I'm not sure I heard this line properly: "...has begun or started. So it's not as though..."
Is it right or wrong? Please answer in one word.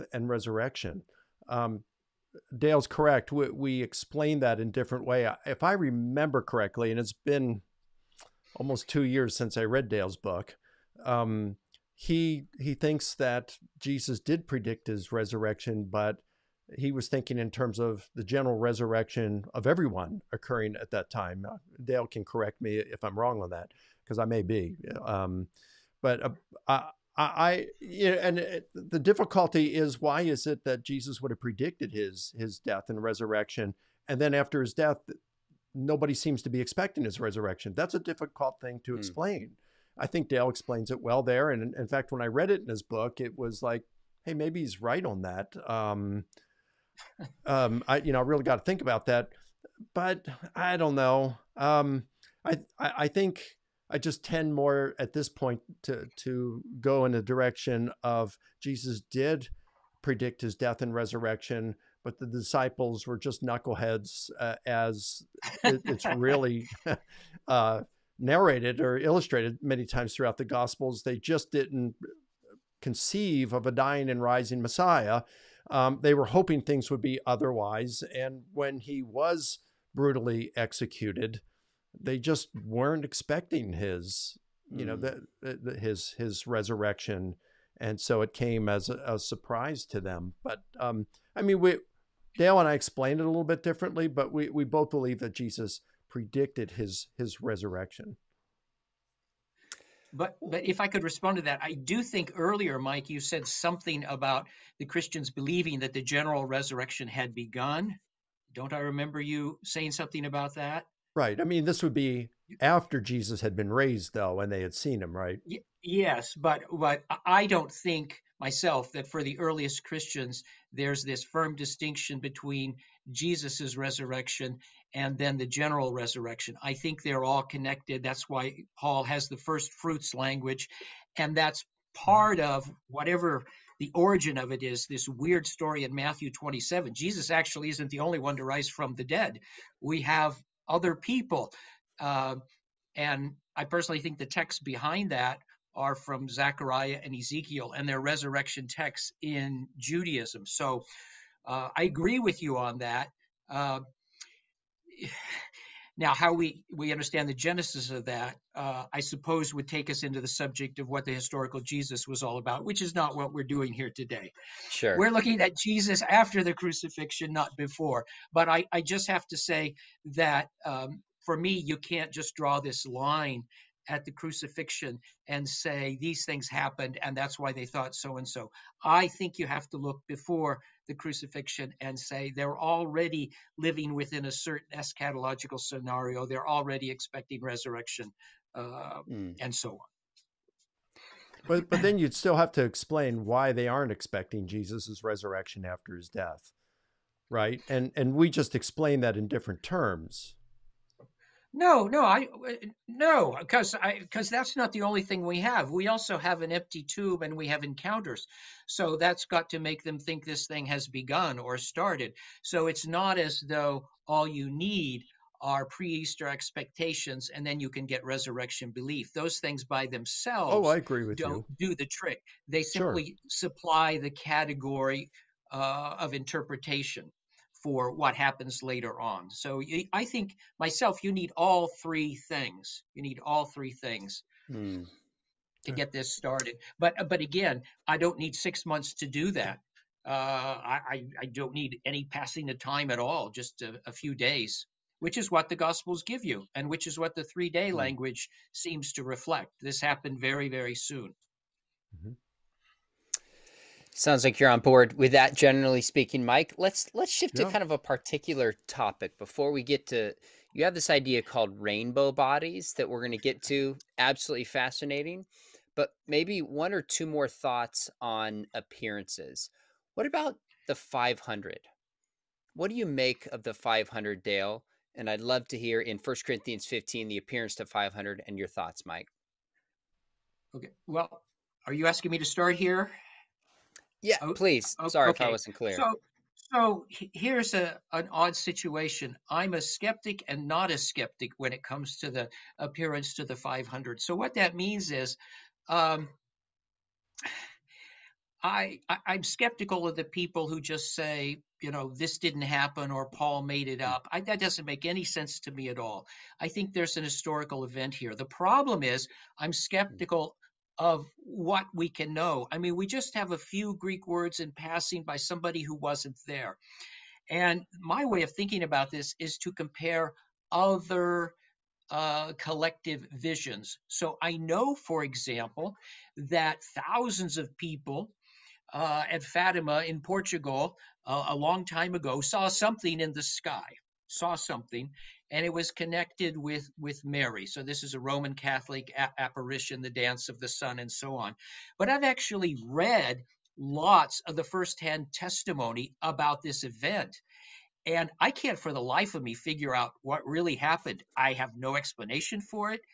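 right.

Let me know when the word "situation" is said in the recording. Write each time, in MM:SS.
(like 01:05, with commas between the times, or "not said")
04:48.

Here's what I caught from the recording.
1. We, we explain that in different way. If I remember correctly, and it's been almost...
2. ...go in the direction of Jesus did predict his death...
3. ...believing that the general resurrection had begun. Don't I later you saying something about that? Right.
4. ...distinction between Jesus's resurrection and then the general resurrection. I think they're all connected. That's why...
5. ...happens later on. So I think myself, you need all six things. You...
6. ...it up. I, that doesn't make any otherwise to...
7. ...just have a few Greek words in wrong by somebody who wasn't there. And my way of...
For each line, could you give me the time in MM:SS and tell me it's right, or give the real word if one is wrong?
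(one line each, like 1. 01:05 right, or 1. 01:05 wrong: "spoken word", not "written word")
1. 00:03 right
2. 00:56 right
3. 01:45 wrong: "remember", not "later"
4. 02:01 right
5. 03:48 wrong: "three", not "six"
6. 05:03 wrong: "sense", not "otherwise"
7. 05:12 wrong: "passing", not "wrong".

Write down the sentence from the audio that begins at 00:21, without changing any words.
Uh, Dale can correct me if I'm wrong on that, because I may be.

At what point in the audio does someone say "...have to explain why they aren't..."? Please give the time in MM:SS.
03:12.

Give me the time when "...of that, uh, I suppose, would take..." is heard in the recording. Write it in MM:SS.
02:37.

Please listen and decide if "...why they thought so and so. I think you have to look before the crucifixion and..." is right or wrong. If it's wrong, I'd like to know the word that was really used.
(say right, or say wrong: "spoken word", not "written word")
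right.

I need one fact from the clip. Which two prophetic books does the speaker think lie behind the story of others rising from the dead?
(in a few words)
Zechariah and Ezekiel.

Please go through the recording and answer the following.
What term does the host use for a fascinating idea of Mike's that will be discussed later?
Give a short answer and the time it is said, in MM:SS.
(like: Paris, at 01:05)
rainbow bodies, at 04:21.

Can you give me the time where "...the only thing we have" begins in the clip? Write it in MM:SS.
03:24.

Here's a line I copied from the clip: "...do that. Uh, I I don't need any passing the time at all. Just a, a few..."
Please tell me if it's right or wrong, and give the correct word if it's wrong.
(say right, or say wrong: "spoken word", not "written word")
right.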